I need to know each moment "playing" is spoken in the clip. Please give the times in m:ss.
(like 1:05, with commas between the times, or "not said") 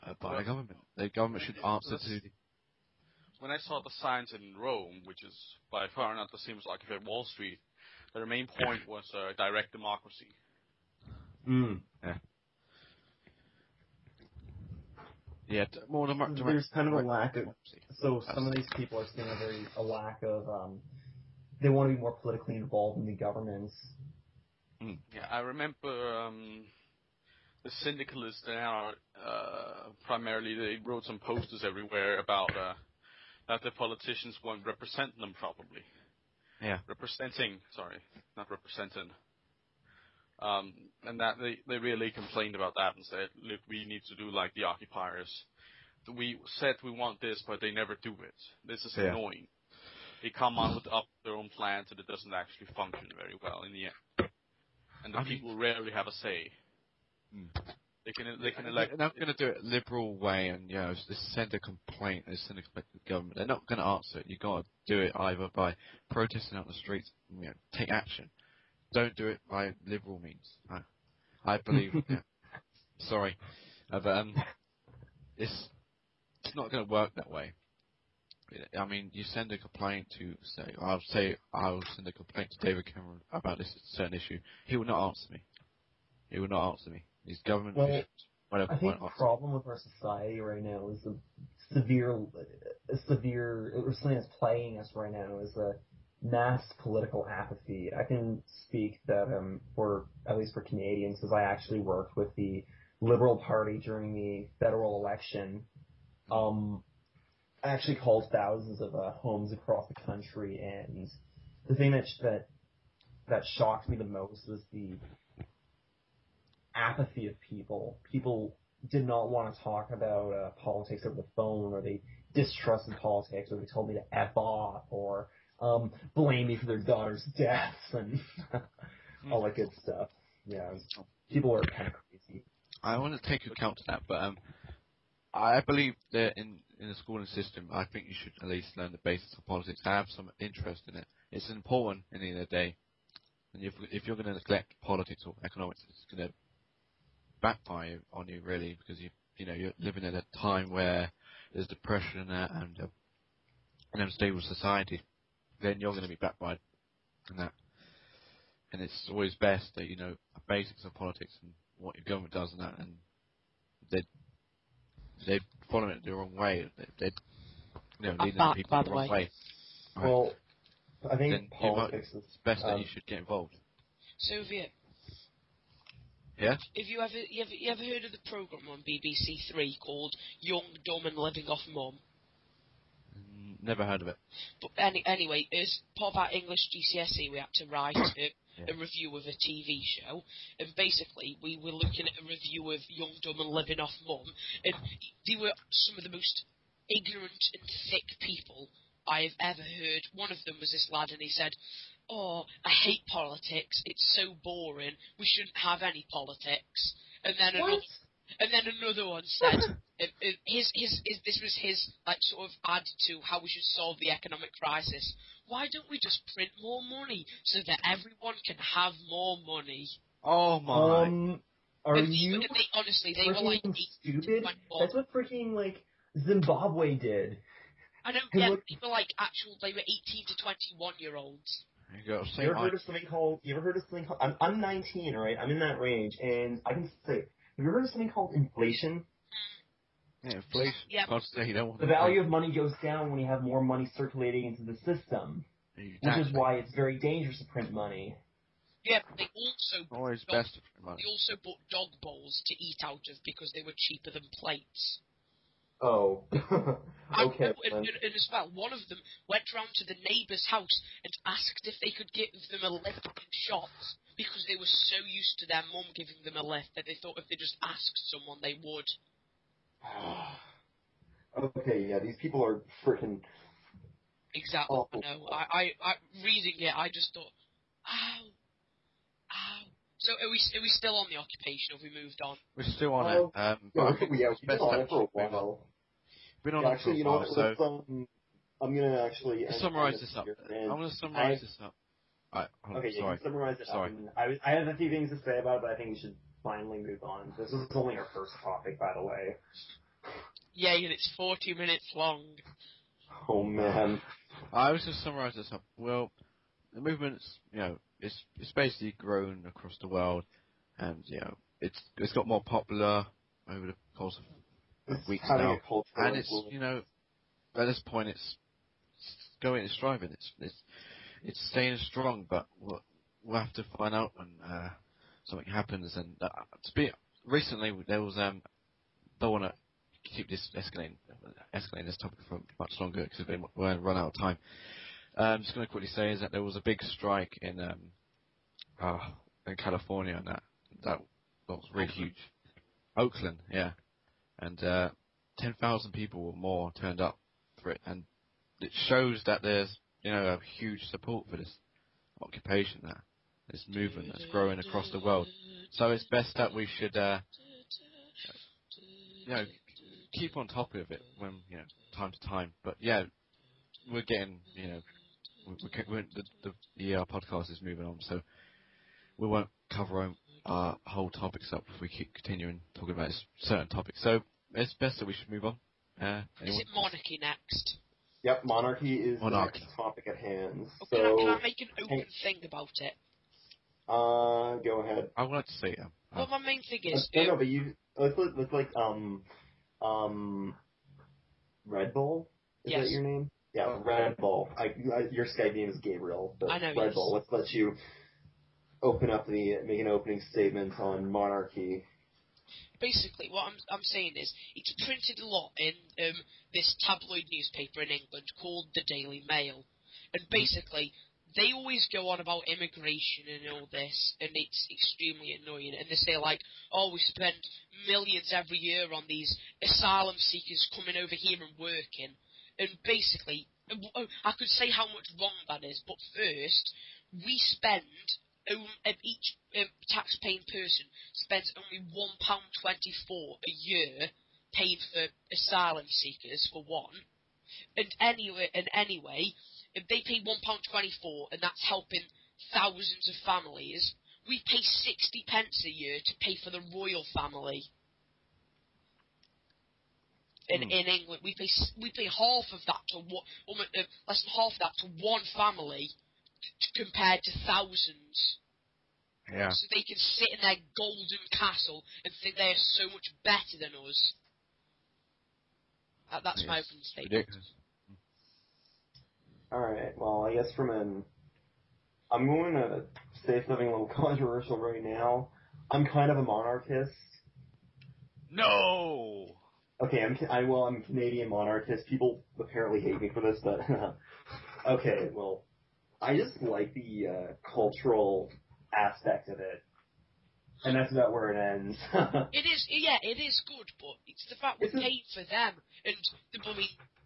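1:34.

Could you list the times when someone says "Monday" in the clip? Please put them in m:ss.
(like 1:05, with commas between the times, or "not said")
not said.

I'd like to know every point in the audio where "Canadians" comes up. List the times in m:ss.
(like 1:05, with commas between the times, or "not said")
1:40, 8:00.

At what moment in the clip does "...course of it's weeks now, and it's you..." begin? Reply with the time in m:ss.
5:13.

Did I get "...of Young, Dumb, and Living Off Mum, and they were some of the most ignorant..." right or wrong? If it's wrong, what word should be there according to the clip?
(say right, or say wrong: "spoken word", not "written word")
right.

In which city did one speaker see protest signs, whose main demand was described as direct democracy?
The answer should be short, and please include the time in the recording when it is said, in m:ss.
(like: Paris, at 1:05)
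Rome, at 0:04.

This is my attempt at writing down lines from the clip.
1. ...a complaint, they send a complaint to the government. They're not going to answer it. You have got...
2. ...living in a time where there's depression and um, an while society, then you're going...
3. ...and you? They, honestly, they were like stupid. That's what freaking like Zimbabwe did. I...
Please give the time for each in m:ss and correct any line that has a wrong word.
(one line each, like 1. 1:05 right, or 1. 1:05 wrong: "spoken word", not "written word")
1. 1:01 right
2. 2:29 wrong: "unstable", not "while"
3. 3:41 right.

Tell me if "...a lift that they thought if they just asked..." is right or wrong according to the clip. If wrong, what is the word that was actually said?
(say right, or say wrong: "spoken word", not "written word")
right.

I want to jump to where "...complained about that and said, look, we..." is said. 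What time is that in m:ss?
0:42.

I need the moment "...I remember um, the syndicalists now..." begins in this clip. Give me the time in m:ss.
0:25.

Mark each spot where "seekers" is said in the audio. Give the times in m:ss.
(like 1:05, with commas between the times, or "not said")
7:00, 7:15.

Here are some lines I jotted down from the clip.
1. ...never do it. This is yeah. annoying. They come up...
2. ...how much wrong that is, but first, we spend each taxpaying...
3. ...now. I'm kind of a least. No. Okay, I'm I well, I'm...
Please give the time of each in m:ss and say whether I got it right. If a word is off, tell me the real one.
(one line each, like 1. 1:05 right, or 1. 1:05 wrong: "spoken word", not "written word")
1. 0:47 right
2. 7:04 right
3. 7:54 wrong: "monarchist", not "least".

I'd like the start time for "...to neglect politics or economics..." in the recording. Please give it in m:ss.
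2:24.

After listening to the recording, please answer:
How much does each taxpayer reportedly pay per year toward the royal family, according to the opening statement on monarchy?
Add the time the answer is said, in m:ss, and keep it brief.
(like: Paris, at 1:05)
60 pence, at 7:24.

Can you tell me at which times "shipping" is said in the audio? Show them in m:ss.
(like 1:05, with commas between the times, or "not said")
not said.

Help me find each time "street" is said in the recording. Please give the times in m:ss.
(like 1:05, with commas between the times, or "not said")
0:07, 1:06.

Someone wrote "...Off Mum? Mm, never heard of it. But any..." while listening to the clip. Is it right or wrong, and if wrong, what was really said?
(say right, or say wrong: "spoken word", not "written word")
right.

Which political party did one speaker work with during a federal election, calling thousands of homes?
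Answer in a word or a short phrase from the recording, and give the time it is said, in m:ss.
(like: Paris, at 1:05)
Liberal Party, at 1:42.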